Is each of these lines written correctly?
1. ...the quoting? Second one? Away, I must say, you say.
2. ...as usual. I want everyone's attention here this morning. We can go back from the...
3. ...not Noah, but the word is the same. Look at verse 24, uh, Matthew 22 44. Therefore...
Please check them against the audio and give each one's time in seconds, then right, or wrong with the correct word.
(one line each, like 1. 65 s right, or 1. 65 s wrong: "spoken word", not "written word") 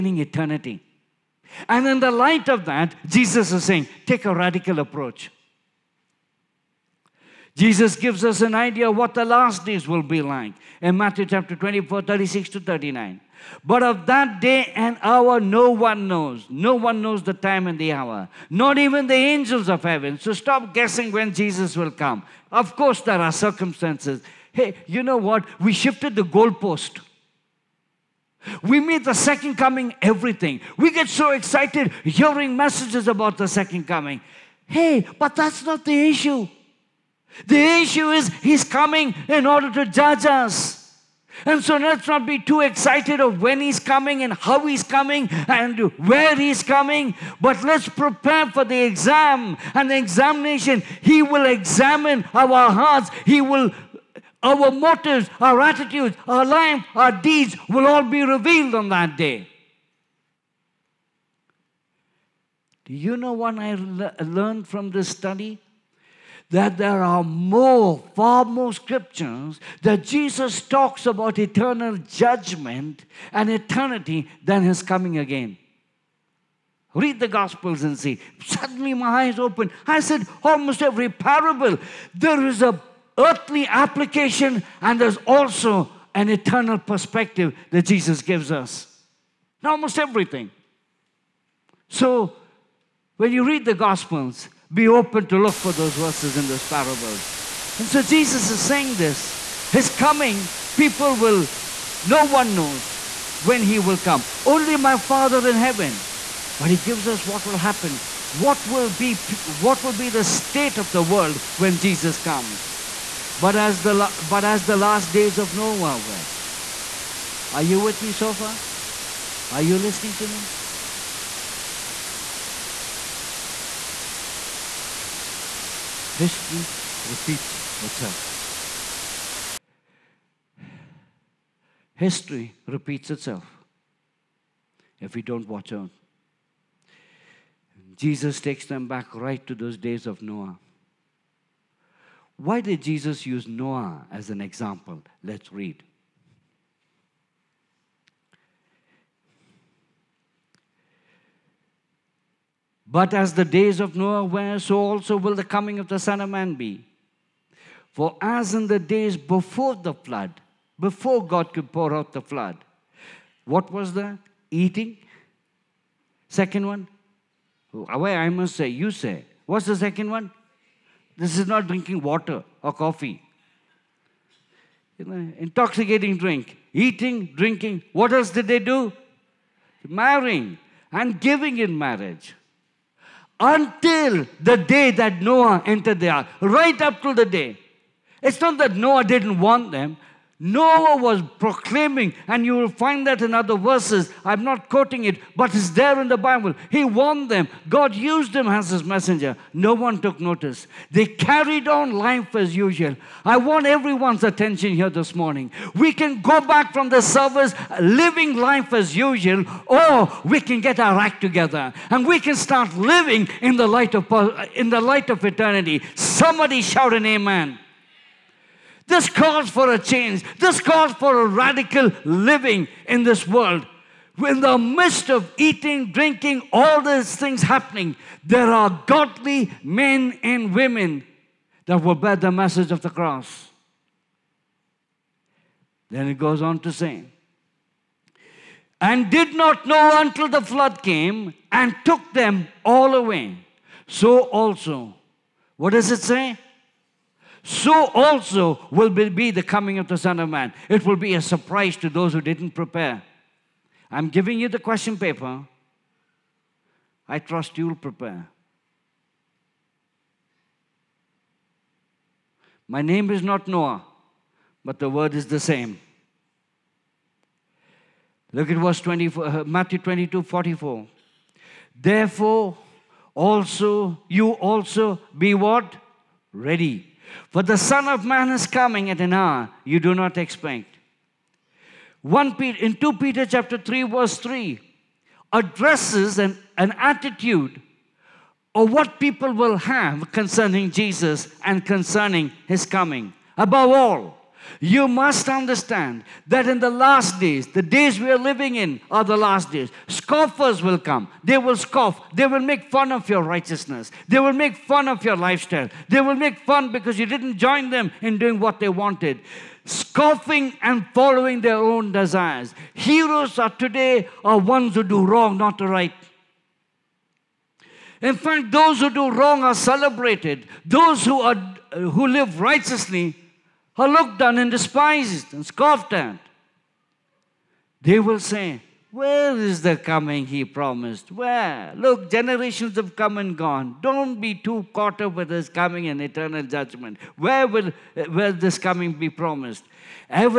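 1. 163 s wrong: "eating", not "quoting"
2. 202 s right
3. 263 s right.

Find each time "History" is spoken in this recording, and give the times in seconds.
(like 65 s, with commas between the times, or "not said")
126 s, 131 s.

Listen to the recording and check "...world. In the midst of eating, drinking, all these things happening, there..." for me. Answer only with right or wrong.
right.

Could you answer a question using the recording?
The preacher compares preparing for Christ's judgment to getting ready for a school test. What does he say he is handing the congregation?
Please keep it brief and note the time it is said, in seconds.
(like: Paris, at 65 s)
The question paper, at 254 s.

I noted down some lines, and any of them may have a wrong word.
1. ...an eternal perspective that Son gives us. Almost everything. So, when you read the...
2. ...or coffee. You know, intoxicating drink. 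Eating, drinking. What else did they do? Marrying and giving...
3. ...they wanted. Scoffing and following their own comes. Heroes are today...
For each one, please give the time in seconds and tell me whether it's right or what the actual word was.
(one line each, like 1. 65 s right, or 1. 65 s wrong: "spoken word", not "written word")
1. 86 s wrong: "Jesus", not "Son"
2. 172 s right
3. 308 s wrong: "desires", not "comes".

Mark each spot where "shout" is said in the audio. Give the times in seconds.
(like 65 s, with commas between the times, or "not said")
216 s.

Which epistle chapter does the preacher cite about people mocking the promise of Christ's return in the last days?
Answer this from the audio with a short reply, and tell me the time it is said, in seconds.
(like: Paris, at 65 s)
2 Peter chapter 3, at 282 s.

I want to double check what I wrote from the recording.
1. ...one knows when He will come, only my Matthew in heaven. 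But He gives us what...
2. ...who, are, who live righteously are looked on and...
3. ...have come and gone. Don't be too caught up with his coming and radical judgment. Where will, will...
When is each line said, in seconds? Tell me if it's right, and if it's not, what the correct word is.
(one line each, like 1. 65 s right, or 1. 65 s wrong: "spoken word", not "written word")
1. 102 s wrong: "Father", not "Matthew"
2. 321 s right
3. 332 s wrong: "eternal", not "radical".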